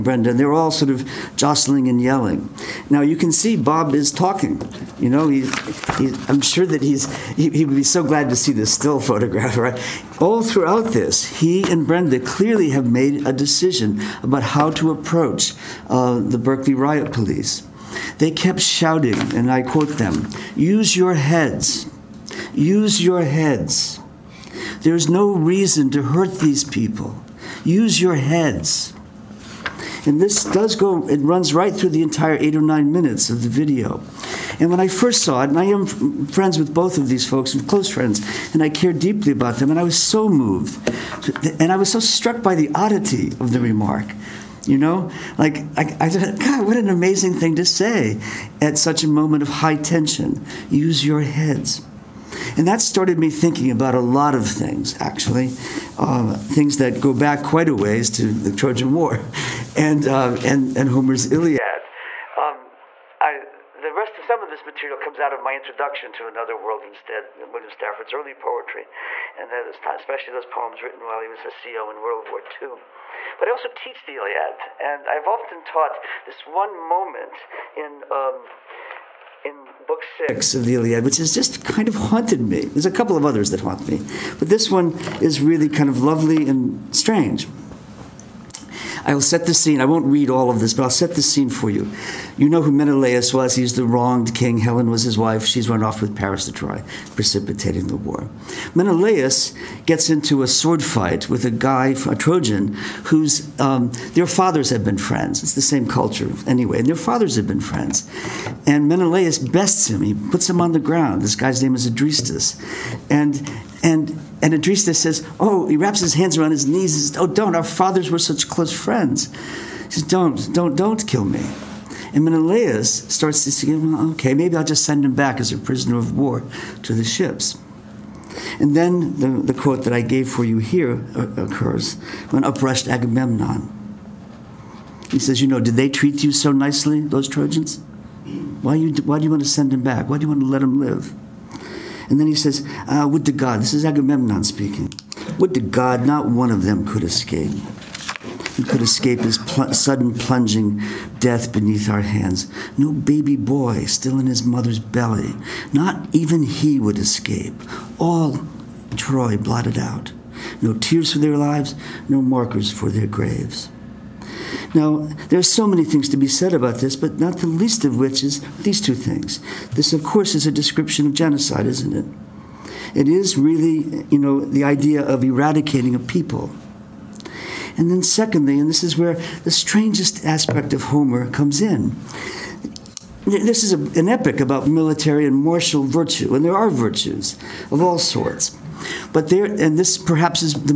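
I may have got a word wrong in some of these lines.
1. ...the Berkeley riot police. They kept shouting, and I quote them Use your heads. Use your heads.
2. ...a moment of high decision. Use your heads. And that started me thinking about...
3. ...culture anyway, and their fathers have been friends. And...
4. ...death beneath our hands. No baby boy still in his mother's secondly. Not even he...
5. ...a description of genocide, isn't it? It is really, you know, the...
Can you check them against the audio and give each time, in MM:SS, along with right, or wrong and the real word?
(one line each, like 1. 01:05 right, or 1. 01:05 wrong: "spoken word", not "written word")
1. 00:16 right
2. 00:49 wrong: "tension", not "decision"
3. 01:45 right
4. 02:31 wrong: "belly", not "secondly"
5. 02:50 right.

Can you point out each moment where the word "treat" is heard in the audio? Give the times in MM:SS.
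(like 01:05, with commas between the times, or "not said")
02:15.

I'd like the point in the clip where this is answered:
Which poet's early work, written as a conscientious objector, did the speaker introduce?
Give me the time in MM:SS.
01:07.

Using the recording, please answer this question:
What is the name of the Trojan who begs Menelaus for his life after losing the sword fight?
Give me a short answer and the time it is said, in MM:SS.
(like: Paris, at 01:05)
Adrestus, at 01:51.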